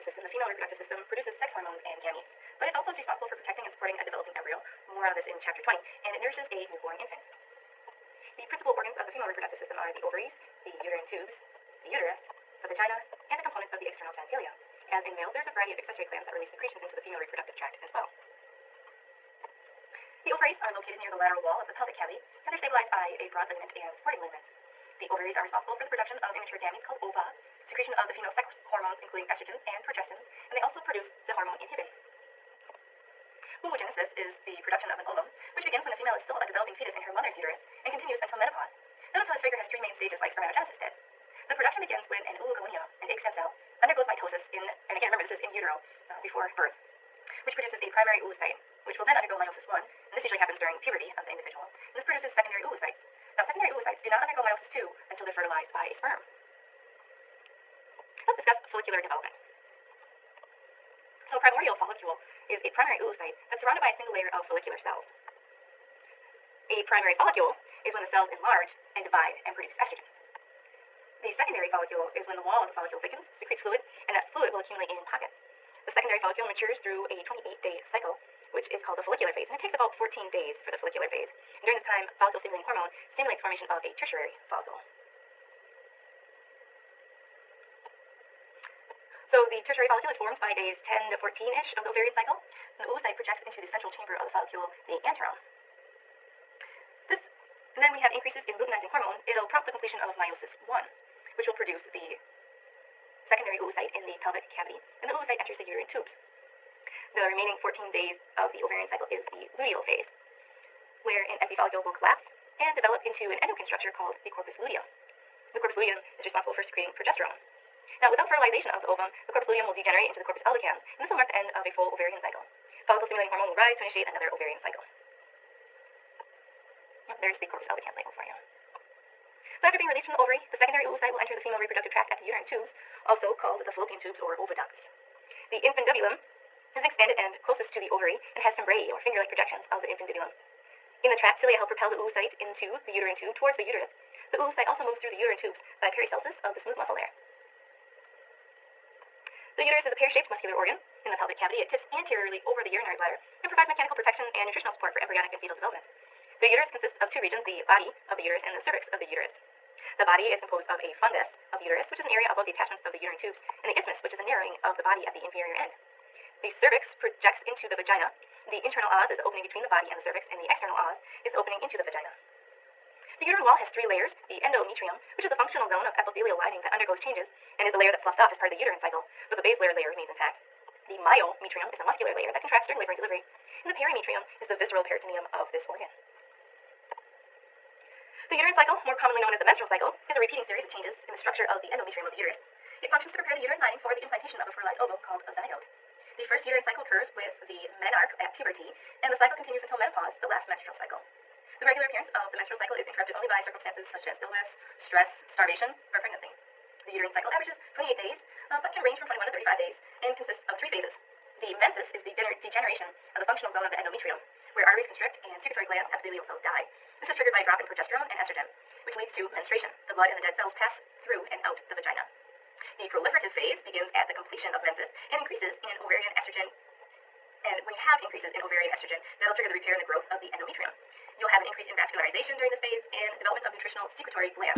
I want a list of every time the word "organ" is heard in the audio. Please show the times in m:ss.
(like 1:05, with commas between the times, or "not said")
0:08, 2:30, 3:05.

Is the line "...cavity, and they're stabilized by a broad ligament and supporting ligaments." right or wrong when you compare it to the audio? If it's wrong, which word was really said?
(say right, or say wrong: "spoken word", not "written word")
right.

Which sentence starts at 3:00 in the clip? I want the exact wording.
The myometrium is the muscular layer that contracts during labor and delivery.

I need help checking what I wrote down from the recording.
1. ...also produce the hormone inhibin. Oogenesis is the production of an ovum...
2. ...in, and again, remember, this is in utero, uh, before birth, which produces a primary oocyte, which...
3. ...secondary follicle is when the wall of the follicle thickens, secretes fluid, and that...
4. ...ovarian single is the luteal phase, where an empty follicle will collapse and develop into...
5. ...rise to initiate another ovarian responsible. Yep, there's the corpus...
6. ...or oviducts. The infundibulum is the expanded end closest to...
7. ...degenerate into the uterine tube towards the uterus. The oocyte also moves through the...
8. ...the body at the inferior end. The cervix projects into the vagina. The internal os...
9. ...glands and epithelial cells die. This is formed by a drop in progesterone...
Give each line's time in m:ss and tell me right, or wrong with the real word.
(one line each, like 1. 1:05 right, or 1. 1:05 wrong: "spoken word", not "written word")
1. 0:30 right
2. 0:44 right
3. 1:11 right
4. 1:48 wrong: "cycle", not "single"
5. 2:03 wrong: "cycle", not "responsible"
6. 2:14 right
7. 2:21 wrong: "oocyte", not "degenerate"
8. 2:44 right
9. 3:35 wrong: "triggered", not "formed".